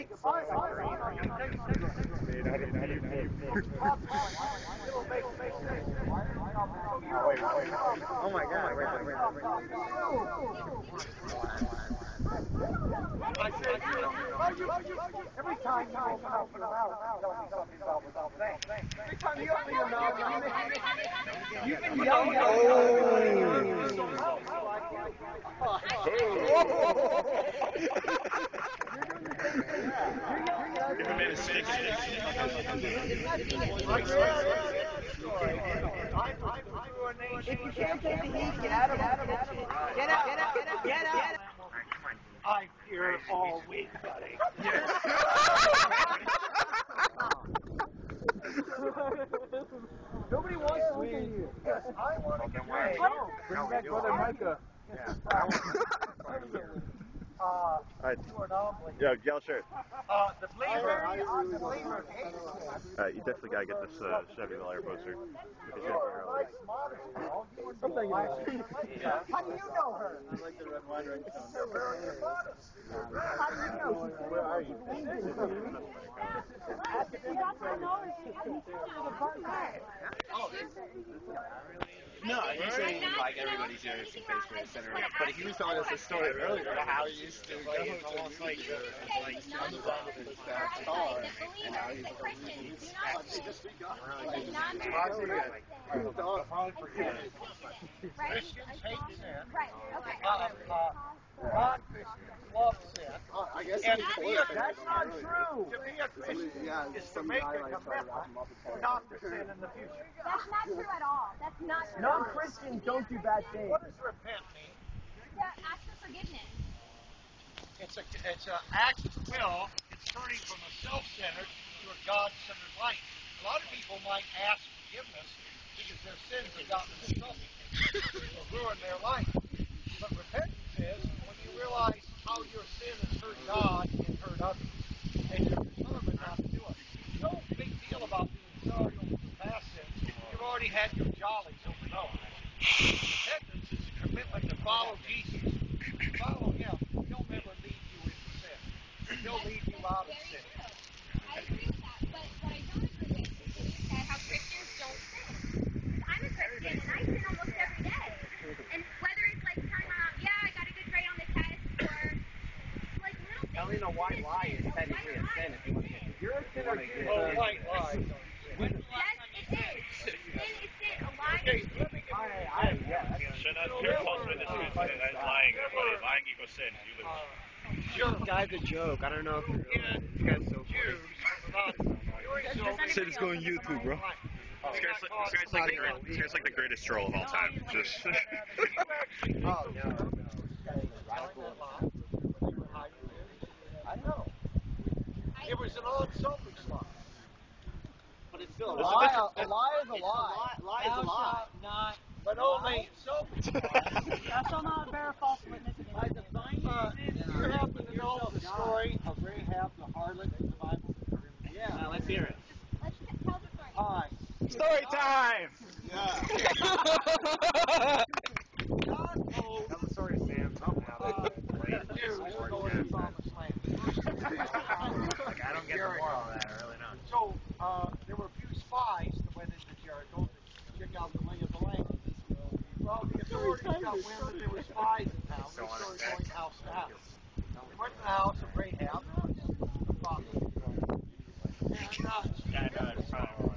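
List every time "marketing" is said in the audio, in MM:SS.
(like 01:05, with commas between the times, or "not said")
not said.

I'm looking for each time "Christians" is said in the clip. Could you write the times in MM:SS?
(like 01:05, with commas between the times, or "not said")
01:41, 01:46, 01:52.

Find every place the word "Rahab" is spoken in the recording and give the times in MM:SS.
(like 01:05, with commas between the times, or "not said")
03:29.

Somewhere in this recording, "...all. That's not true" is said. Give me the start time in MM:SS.
01:51.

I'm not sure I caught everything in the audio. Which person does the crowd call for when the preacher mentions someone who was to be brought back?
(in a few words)
Brother Micah.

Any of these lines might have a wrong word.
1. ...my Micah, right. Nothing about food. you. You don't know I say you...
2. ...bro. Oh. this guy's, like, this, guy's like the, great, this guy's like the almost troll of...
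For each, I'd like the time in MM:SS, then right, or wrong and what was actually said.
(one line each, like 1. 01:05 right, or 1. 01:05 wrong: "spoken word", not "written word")
1. 00:08 wrong: "God", not "Micah"
2. 03:03 wrong: "greatest", not "almost".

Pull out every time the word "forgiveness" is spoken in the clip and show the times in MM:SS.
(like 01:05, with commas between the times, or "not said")
01:56, 02:04.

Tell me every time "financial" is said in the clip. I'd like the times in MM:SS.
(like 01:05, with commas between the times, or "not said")
not said.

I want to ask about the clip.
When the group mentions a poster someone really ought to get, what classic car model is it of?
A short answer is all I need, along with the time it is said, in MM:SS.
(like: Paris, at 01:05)
Chevy Bel Air, at 01:04.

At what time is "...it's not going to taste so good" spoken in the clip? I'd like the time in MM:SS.
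00:00.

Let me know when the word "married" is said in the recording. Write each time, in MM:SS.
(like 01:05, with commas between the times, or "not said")
00:52.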